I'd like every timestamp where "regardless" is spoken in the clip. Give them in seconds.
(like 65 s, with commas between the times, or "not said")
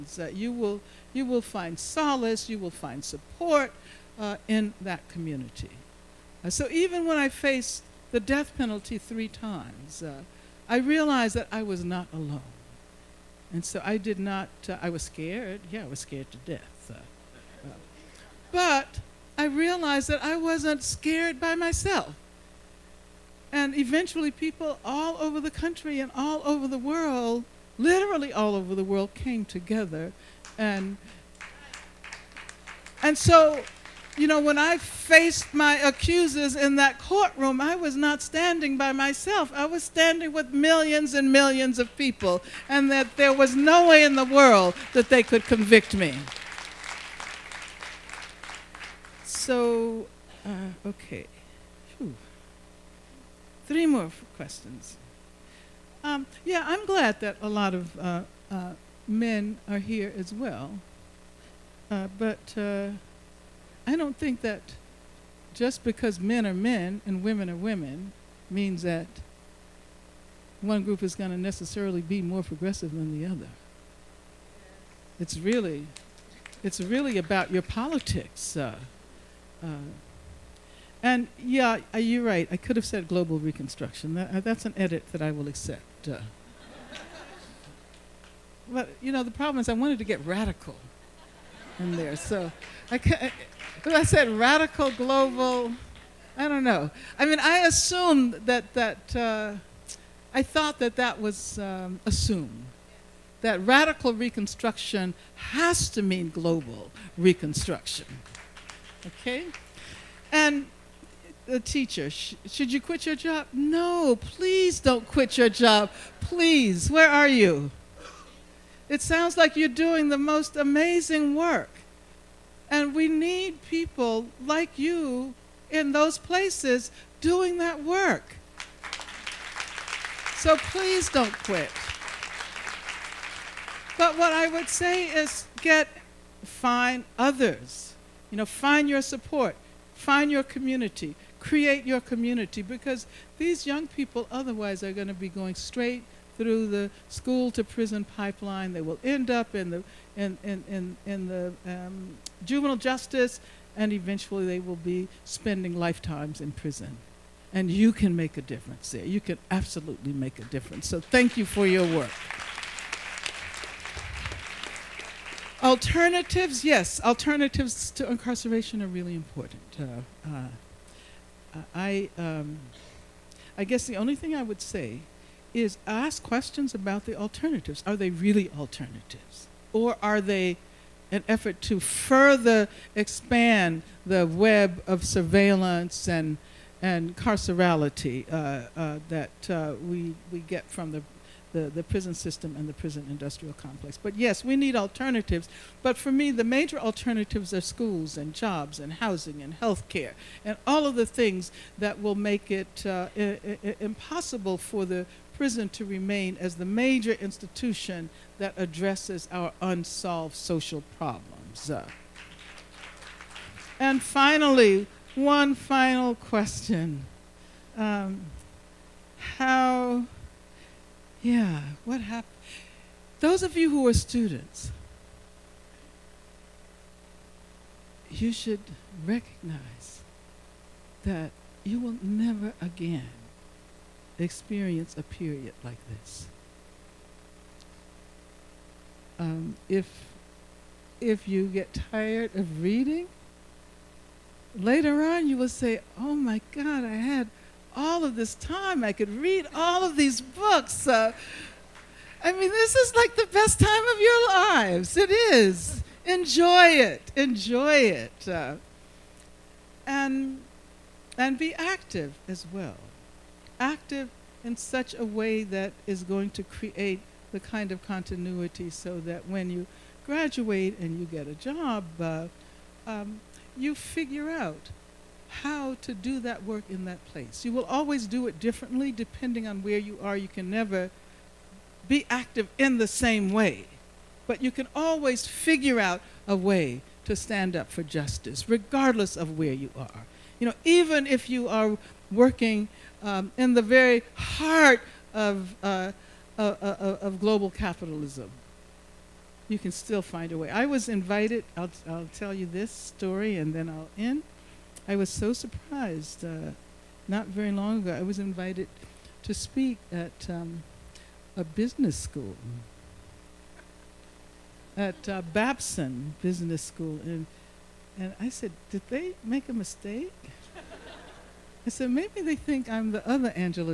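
288 s.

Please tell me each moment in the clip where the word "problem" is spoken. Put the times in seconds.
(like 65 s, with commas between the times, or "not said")
89 s, 210 s.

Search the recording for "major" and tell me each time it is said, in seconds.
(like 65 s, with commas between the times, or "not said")
196 s, 206 s.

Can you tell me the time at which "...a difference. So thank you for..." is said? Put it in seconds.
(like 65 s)
160 s.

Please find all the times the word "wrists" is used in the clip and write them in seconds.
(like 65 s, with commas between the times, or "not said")
not said.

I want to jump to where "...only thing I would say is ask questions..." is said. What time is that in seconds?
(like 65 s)
173 s.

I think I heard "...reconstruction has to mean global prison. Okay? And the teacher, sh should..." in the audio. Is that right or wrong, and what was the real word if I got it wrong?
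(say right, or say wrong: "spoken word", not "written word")
wrong: "reconstruction", not "prison".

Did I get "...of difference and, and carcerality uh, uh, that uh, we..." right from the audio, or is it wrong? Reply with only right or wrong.
wrong.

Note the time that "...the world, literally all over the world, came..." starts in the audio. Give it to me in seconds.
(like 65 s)
26 s.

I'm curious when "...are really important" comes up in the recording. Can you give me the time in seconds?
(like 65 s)
168 s.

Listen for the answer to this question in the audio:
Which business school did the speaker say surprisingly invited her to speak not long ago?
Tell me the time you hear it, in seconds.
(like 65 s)
315 s.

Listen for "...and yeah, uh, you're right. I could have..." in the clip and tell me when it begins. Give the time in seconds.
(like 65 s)
81 s.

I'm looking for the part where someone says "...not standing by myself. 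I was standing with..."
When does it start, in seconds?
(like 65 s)
37 s.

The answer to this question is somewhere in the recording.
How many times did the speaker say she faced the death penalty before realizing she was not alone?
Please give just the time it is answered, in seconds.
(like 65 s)
8 s.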